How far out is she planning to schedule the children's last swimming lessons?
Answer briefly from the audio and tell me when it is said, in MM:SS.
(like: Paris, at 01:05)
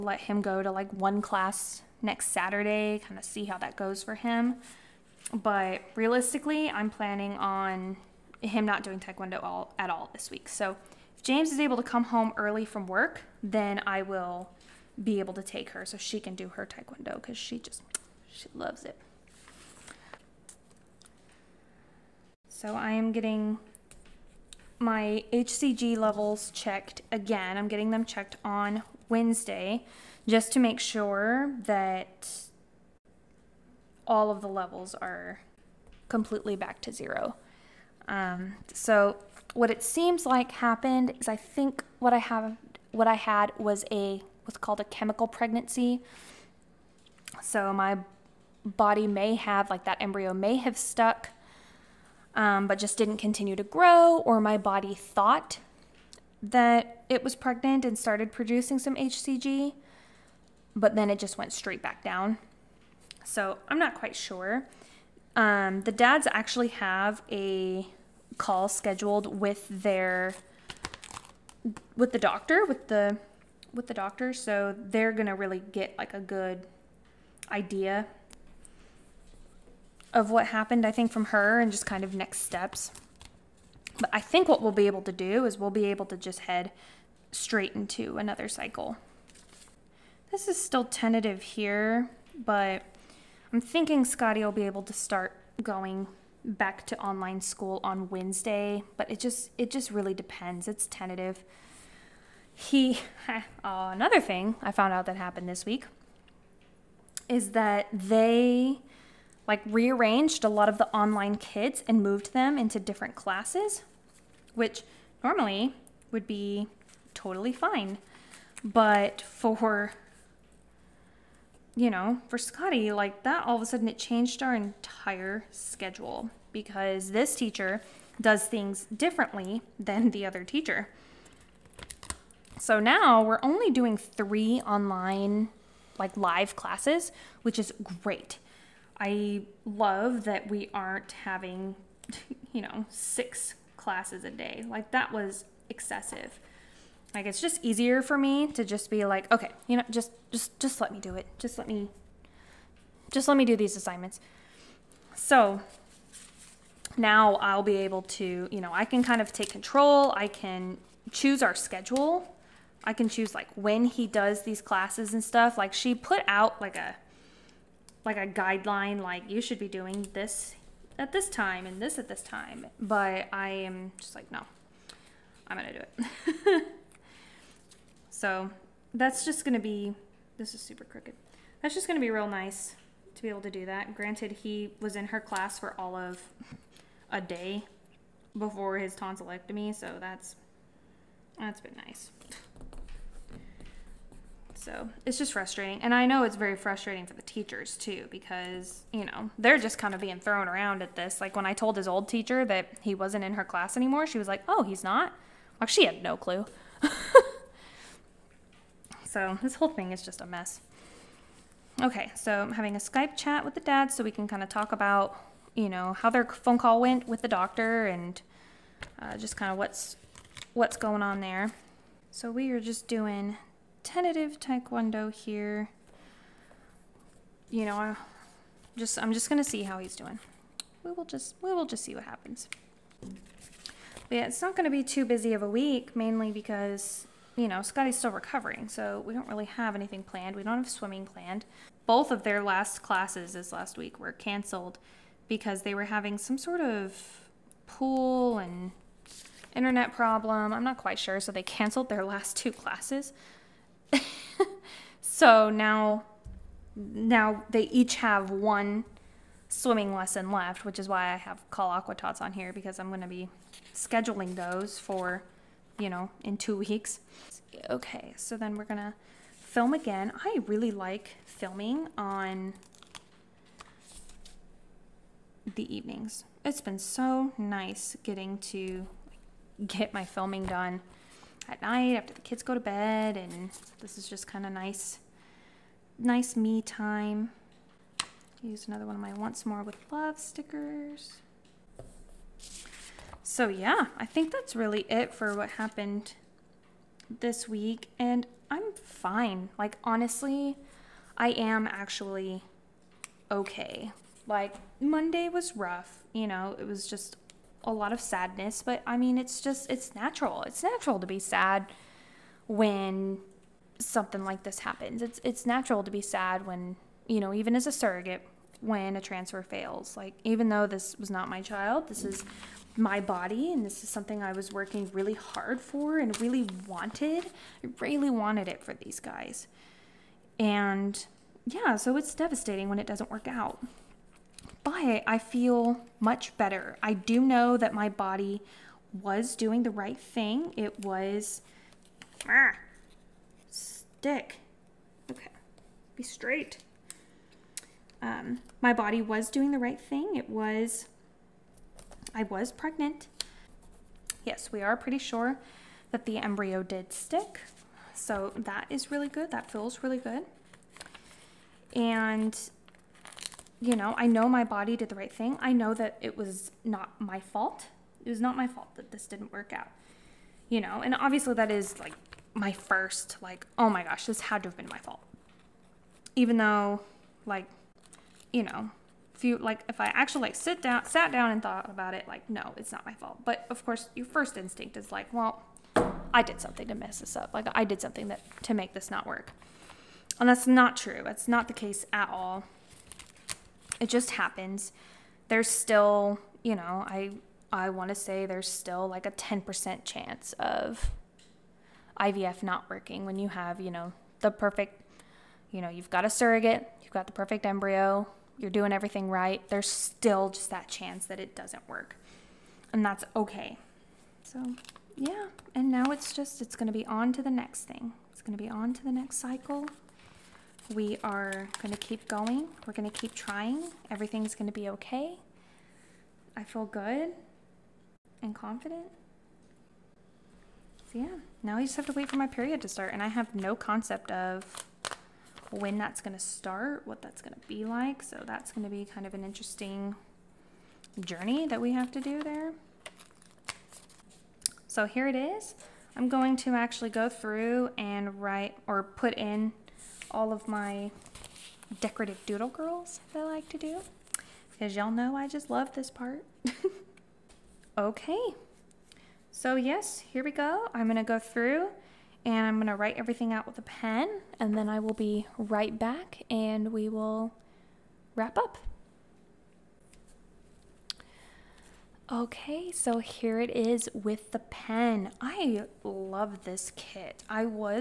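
2 weeks, at 04:26.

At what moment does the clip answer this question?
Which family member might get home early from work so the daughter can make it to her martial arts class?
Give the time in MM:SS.
00:11.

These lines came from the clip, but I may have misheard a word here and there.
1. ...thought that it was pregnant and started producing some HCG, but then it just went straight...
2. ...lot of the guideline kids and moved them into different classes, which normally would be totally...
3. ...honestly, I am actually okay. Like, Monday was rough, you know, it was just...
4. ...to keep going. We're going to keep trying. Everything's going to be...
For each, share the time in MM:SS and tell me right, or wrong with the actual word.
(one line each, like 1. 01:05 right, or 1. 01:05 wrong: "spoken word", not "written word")
1. 00:54 right
2. 01:50 wrong: "online", not "guideline"
3. 04:59 right
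4. 07:01 right.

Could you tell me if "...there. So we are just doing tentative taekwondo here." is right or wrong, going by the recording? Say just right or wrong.
right.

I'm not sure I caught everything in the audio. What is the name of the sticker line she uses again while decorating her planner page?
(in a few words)
Once More With Love.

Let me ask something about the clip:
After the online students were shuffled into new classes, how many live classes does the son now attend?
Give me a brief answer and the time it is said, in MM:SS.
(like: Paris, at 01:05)
3, at 02:13.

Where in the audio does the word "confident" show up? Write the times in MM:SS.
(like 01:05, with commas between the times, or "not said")
07:08.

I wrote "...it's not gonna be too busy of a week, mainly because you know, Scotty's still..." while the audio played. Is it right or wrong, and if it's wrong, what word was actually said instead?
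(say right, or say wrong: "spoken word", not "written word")
right.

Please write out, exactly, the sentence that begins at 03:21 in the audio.
Like when I told his old teacher that he wasn't in her class anymore, she was like, oh, he's not?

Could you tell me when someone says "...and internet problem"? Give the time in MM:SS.
04:08.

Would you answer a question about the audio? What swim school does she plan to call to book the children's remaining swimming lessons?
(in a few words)
Aqua Tots.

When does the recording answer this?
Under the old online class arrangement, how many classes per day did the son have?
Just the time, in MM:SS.
02:22.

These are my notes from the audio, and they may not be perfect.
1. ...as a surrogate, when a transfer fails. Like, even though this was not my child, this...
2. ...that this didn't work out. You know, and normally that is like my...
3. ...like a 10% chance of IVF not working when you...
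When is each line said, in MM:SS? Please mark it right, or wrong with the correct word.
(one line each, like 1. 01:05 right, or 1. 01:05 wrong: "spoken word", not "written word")
1. 05:17 right
2. 06:08 wrong: "obviously", not "normally"
3. 06:38 right.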